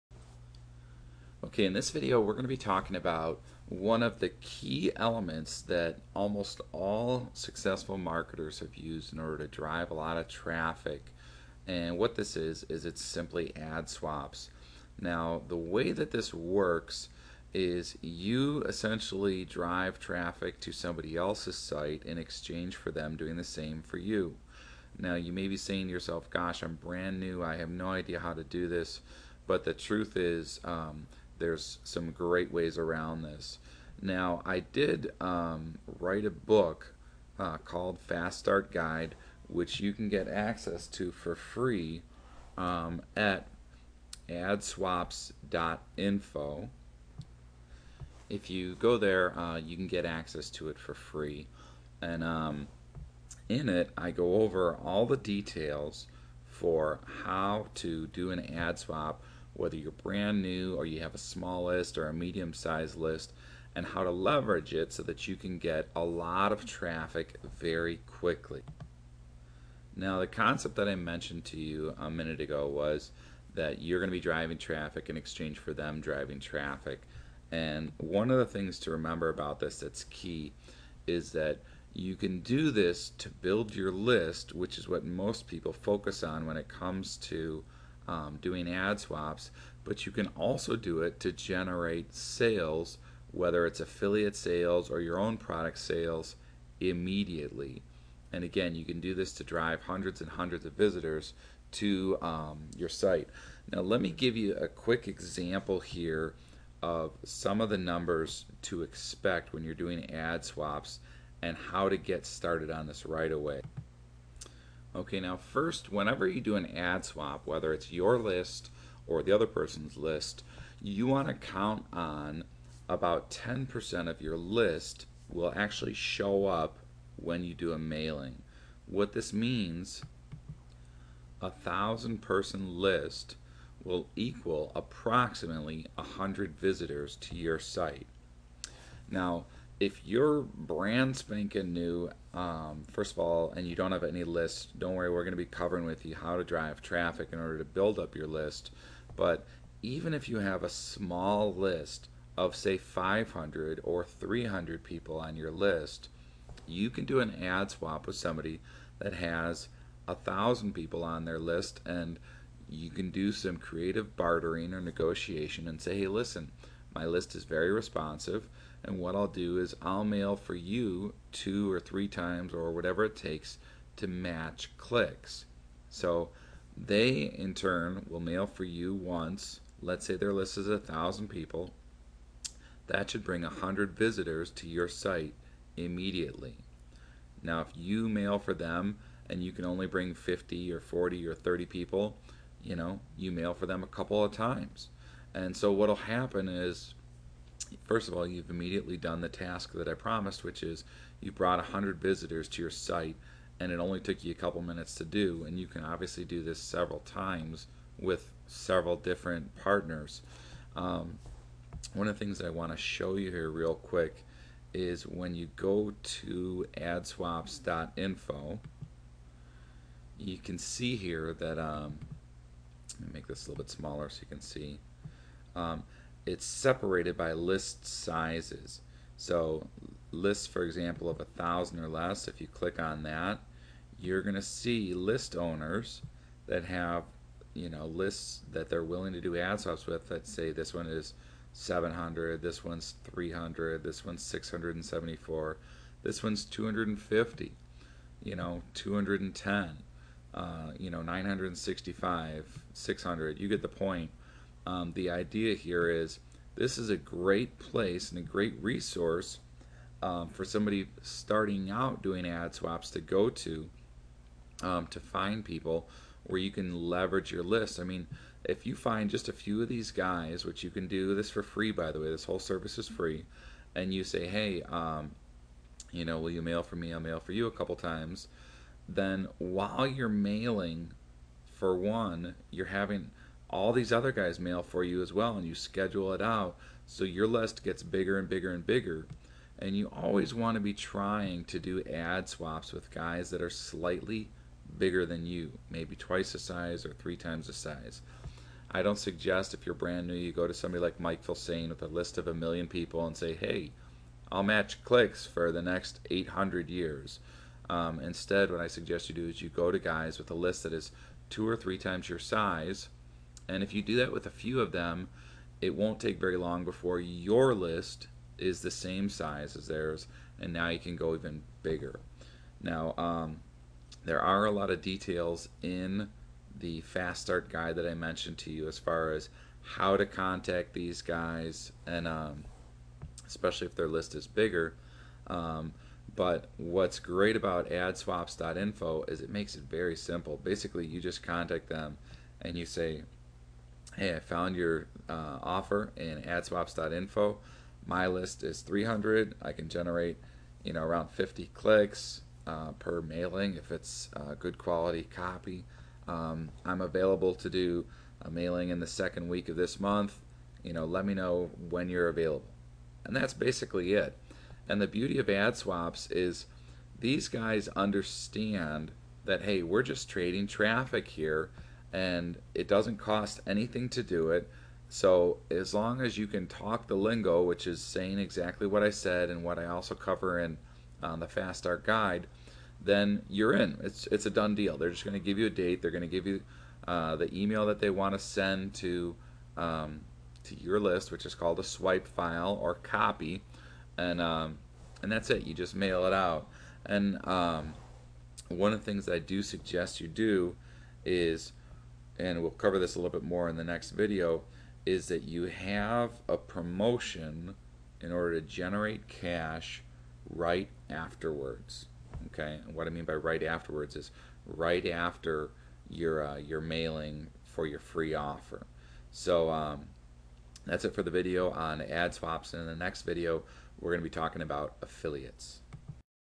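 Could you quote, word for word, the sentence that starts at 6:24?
They're just going to give you a date.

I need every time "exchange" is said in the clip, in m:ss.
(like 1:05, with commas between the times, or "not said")
0:22, 1:15.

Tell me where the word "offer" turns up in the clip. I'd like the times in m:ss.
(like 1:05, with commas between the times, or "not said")
5:45, 6:58.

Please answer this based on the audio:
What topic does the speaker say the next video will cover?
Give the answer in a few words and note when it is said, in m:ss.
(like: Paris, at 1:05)
affiliates, at 7:04.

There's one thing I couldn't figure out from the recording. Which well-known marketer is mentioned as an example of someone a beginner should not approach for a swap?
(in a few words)
Mike Filsaime.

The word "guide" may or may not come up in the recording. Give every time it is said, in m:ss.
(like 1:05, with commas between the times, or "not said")
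0:38, 5:27, 6:21.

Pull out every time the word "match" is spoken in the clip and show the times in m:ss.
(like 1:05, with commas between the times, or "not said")
2:54, 5:04.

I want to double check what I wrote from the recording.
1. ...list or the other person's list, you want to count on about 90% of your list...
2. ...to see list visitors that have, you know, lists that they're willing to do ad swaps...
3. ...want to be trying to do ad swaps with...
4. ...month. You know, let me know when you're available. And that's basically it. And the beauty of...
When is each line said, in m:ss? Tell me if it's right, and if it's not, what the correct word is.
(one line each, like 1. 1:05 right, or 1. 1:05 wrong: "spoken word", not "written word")
1. 1:58 wrong: "10", not "90"
2. 3:54 wrong: "owners", not "visitors"
3. 4:50 right
4. 5:59 right.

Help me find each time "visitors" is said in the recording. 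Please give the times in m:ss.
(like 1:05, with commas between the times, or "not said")
1:40, 2:16, 3:03, 3:21.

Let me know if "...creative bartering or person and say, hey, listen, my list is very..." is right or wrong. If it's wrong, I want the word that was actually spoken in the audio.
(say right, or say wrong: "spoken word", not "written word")
wrong: "negotiation", not "person".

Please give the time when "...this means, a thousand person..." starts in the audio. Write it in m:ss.
2:09.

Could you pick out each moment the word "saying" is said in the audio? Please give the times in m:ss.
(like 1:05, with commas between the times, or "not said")
0:25, 6:17.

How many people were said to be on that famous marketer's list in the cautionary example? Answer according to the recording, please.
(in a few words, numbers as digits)
a million.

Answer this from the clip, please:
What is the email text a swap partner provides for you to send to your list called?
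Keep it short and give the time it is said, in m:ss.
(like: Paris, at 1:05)
swipe file, at 6:31.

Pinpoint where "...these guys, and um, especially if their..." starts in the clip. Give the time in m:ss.
5:30.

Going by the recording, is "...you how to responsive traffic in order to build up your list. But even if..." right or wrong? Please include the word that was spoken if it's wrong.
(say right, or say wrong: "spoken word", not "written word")
wrong: "drive", not "responsive".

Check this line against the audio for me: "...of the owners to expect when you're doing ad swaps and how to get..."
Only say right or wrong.
wrong.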